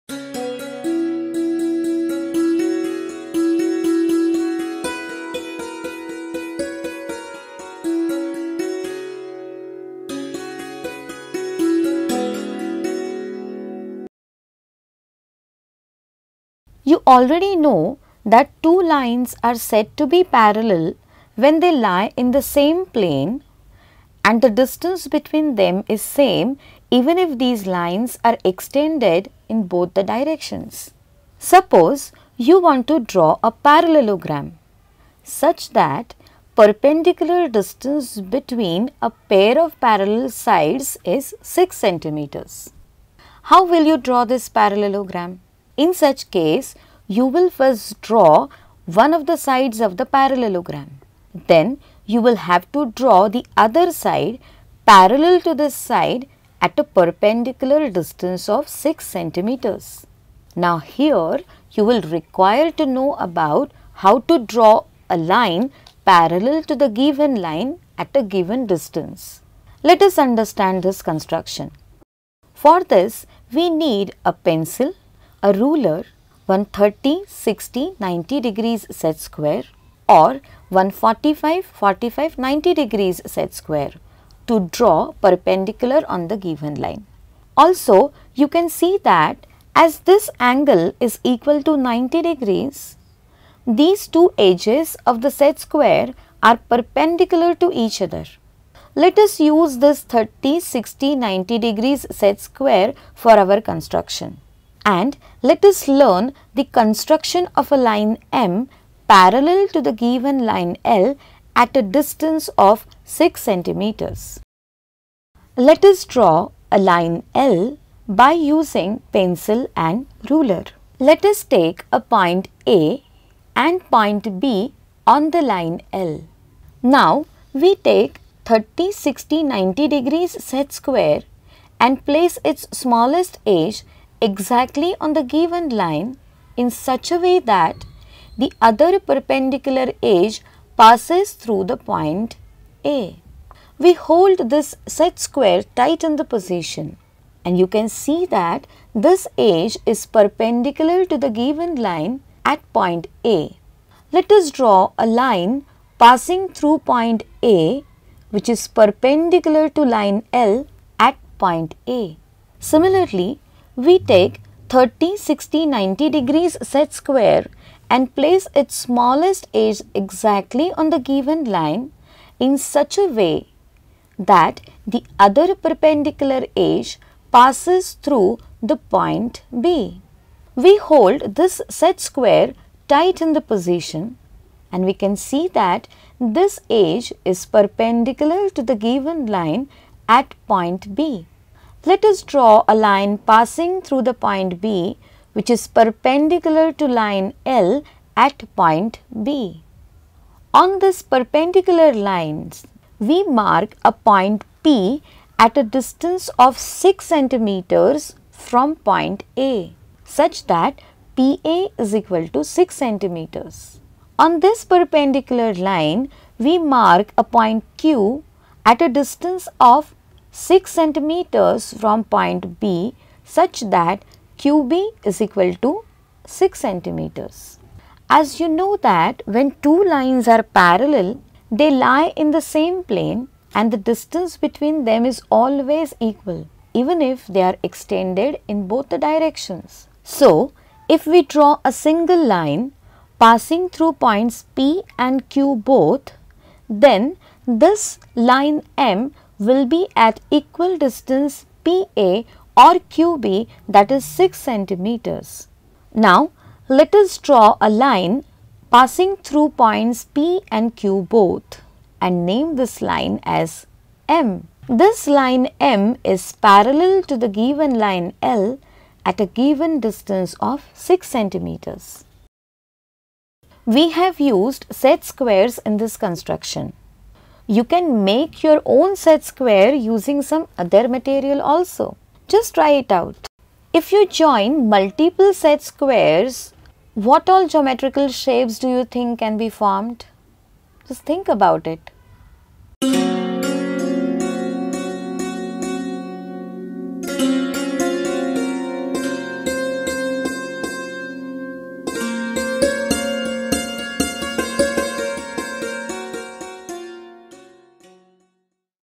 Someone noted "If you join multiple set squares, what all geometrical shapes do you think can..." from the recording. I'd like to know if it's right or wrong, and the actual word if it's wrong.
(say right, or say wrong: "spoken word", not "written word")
right.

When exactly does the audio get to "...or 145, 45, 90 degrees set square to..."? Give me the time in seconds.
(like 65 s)
80 s.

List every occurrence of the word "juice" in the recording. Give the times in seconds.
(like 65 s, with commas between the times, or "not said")
not said.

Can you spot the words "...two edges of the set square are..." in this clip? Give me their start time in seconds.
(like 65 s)
94 s.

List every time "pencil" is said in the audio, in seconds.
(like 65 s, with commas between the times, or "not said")
74 s, 119 s.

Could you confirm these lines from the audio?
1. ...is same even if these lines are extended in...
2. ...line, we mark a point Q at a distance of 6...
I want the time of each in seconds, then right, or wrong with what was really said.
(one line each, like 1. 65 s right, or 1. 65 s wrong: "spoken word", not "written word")
1. 25 s right
2. 215 s right.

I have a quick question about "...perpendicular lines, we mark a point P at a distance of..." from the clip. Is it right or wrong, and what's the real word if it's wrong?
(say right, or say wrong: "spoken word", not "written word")
right.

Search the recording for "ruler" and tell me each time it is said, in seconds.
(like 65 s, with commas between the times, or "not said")
75 s, 120 s.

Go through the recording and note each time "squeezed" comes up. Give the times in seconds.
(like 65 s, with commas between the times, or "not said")
not said.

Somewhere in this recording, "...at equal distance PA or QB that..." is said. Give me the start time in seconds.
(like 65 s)
250 s.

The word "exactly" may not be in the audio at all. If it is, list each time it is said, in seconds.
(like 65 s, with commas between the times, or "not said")
134 s, 169 s.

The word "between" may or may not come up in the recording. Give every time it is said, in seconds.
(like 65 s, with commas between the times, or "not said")
25 s, 38 s, 234 s.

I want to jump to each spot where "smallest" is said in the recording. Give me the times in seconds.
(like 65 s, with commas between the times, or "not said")
132 s, 168 s.